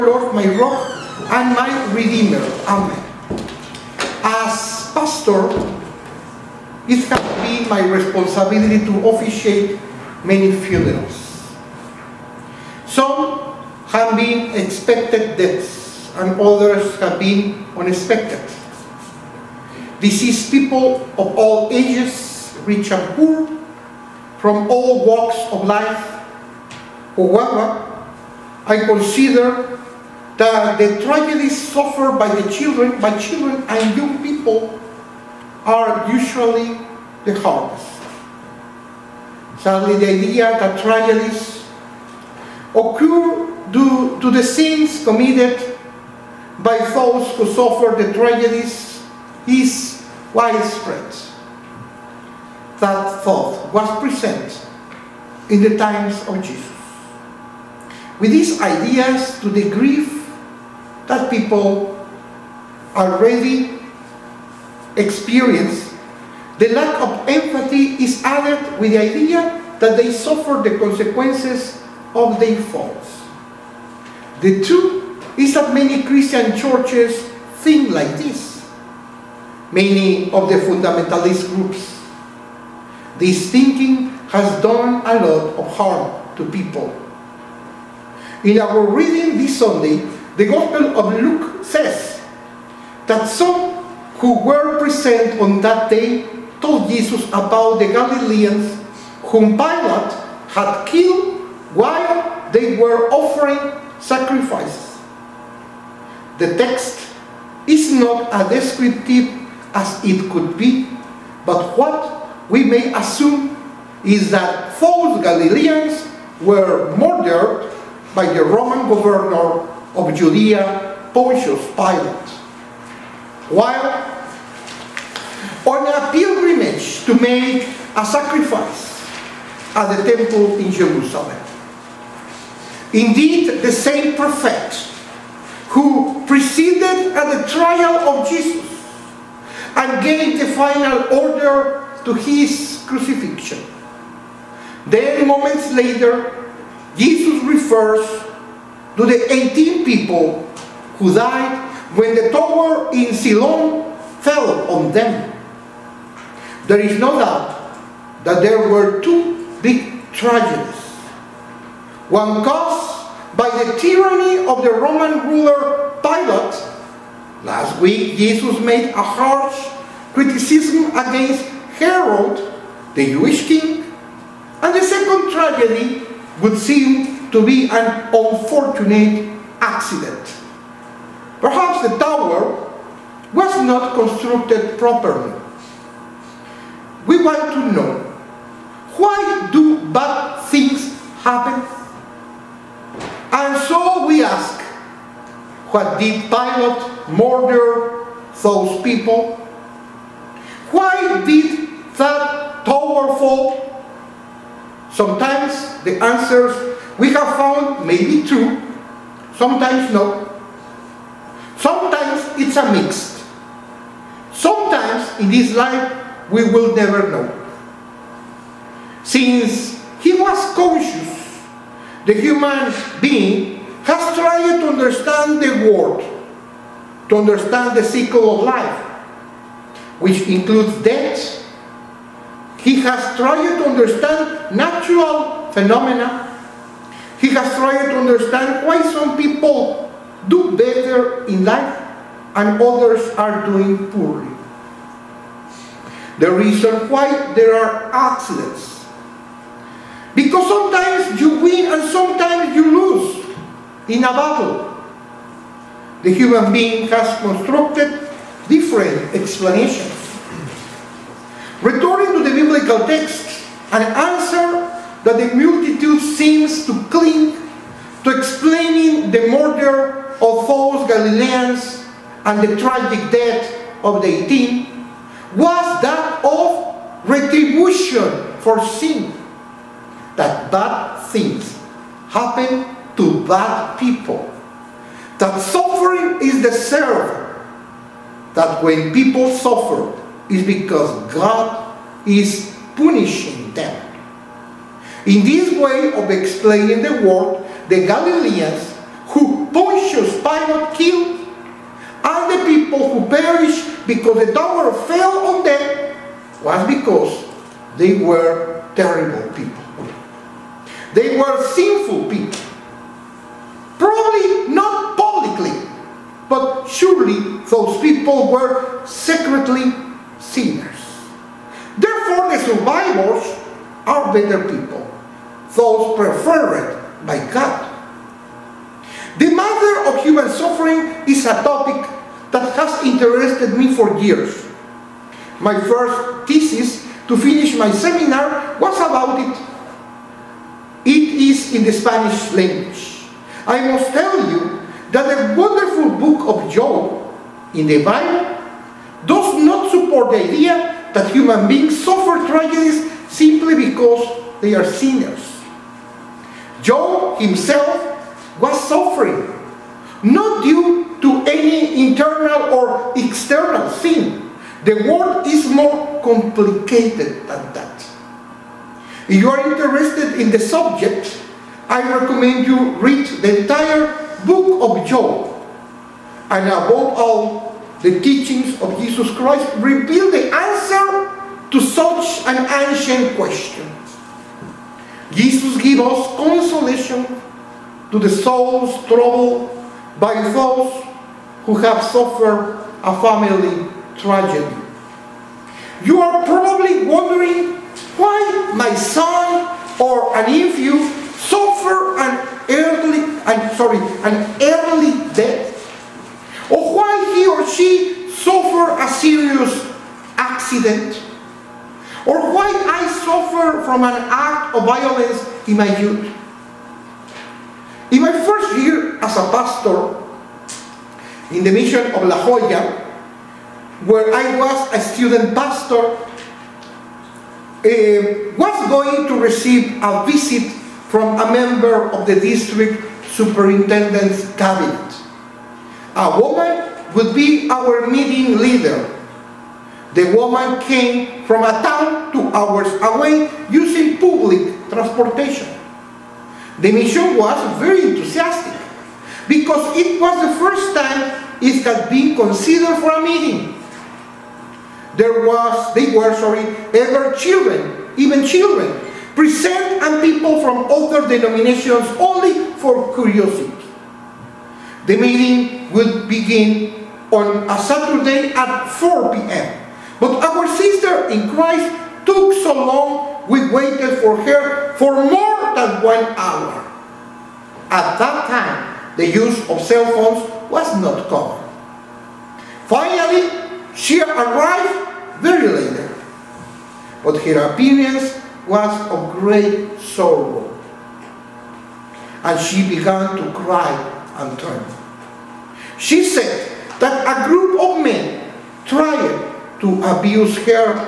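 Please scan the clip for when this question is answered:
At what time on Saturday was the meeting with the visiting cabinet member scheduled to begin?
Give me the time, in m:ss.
7:48.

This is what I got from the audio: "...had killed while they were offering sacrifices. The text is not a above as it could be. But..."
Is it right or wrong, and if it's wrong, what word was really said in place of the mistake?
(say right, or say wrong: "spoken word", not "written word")
wrong: "descriptive", not "above".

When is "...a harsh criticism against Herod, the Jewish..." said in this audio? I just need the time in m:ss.
2:48.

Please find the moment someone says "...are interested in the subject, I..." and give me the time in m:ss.
6:09.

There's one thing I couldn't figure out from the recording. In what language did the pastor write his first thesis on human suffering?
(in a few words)
Spanish.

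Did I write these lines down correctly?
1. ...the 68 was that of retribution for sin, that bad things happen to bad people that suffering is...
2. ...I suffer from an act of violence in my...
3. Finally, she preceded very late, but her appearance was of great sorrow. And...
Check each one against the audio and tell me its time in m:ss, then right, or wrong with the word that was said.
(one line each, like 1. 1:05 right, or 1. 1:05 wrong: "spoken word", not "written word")
1. 4:34 wrong: "18", not "68"
2. 6:52 right
3. 8:02 wrong: "arrived", not "preceded".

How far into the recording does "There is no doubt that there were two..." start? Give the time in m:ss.
2:36.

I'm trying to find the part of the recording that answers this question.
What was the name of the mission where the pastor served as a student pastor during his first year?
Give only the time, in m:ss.
7:02.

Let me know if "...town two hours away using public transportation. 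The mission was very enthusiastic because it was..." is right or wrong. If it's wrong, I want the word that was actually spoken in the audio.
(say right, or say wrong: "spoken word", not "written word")
right.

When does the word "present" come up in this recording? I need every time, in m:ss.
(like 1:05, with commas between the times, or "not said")
0:53, 1:34, 7:39.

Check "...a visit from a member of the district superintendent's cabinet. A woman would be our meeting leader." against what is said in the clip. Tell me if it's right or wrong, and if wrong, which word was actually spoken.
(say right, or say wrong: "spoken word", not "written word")
right.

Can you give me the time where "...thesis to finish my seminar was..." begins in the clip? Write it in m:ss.
5:36.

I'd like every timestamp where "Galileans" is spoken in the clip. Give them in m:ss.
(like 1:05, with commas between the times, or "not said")
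1:37, 1:55, 4:30, 4:57.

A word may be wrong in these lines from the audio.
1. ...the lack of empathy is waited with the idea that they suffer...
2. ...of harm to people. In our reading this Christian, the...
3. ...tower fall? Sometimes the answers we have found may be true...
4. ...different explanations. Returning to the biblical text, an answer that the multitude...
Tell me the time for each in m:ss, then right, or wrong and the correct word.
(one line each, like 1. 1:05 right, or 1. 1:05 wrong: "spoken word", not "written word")
1. 1:06 wrong: "added", not "waited"
2. 1:25 wrong: "Sunday", not "Christian"
3. 3:22 right
4. 4:18 right.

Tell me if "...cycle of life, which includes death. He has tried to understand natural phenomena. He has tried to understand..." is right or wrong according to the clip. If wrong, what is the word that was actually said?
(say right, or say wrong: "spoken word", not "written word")
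right.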